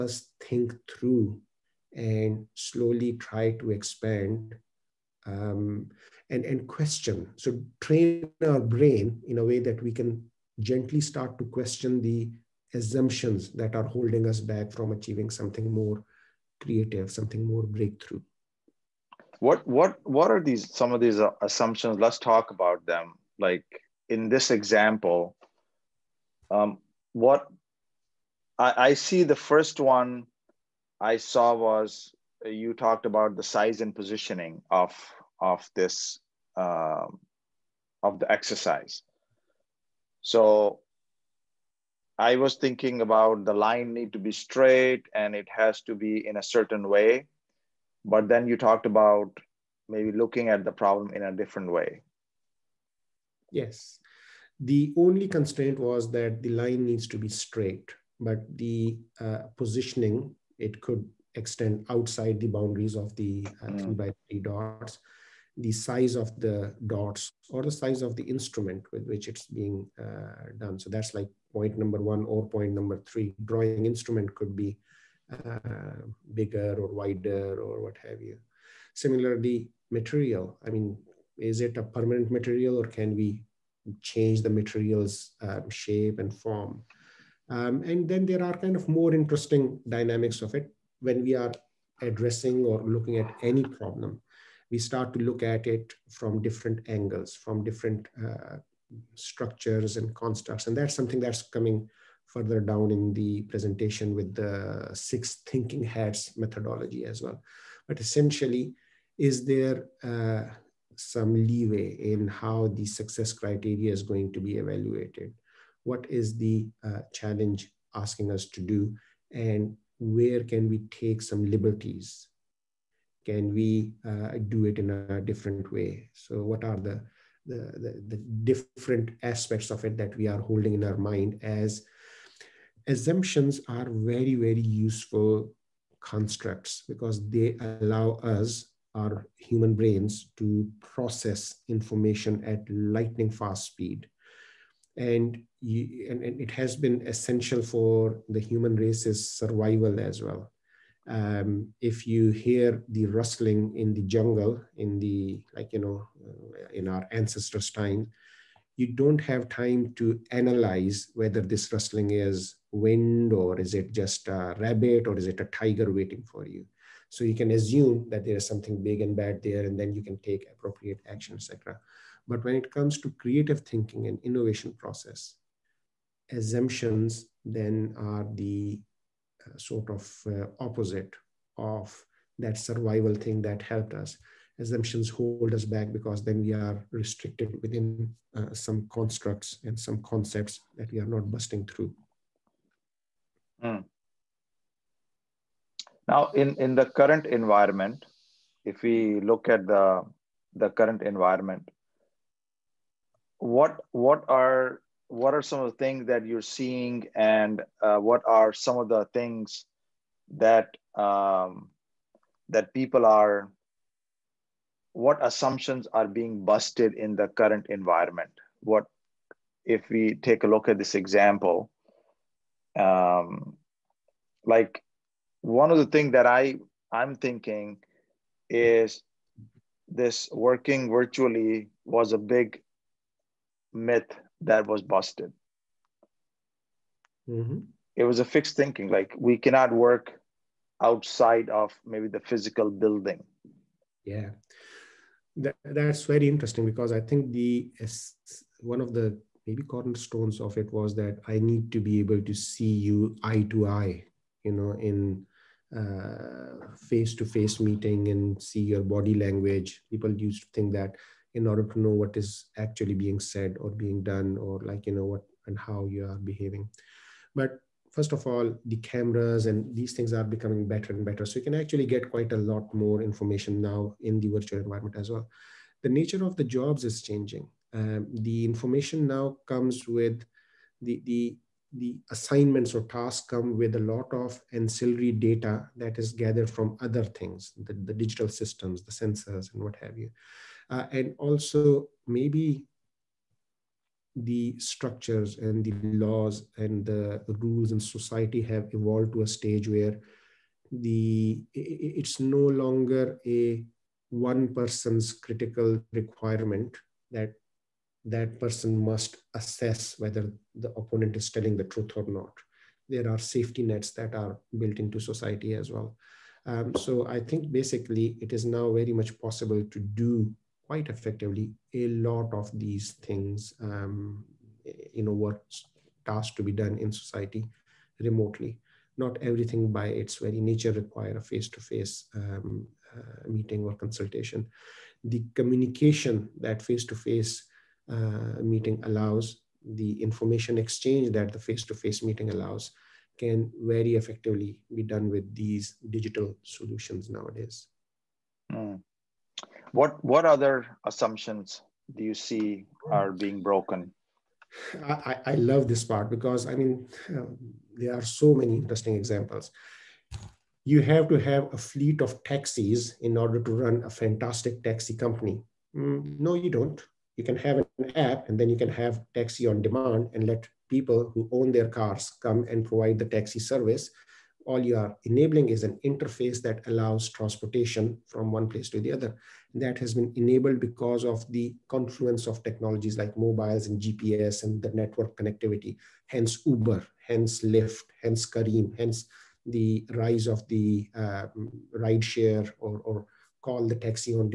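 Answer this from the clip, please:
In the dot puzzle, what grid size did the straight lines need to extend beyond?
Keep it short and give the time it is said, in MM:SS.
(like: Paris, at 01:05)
three by three, at 01:03.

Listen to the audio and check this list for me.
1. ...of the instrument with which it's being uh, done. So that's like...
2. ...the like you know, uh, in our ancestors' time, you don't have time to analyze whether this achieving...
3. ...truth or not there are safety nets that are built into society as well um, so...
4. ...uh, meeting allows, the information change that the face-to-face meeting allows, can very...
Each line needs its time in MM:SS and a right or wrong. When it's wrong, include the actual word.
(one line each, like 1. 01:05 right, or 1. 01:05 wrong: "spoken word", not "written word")
1. 01:08 right
2. 02:34 wrong: "rustling", not "achieving"
3. 05:11 right
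4. 05:37 wrong: "exchange", not "change".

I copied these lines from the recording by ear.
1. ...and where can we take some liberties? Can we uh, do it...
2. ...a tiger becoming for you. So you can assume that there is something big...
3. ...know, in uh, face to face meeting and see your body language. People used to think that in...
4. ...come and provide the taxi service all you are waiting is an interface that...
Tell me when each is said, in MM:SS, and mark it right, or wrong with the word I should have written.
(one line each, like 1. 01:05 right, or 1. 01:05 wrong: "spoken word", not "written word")
1. 01:59 right
2. 02:45 wrong: "waiting", not "becoming"
3. 04:14 right
4. 06:12 wrong: "enabling", not "waiting".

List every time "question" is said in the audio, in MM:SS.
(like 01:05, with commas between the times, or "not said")
00:06, 00:11.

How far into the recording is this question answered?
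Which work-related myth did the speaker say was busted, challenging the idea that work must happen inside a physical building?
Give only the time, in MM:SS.
03:50.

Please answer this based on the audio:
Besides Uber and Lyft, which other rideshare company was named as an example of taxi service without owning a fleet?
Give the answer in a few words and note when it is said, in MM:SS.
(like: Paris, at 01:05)
Careem, at 06:28.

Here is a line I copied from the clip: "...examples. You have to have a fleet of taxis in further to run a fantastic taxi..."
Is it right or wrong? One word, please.
wrong.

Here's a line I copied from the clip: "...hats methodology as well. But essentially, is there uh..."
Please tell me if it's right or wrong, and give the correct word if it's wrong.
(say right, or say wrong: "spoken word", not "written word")
right.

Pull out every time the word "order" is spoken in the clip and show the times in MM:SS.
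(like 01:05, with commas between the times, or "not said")
04:21, 06:03.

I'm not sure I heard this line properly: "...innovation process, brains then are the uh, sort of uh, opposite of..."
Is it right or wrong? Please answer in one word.
wrong.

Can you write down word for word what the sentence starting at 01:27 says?
Um, and then there are kind of more interesting dynamics of it when we are addressing or looking at any problem.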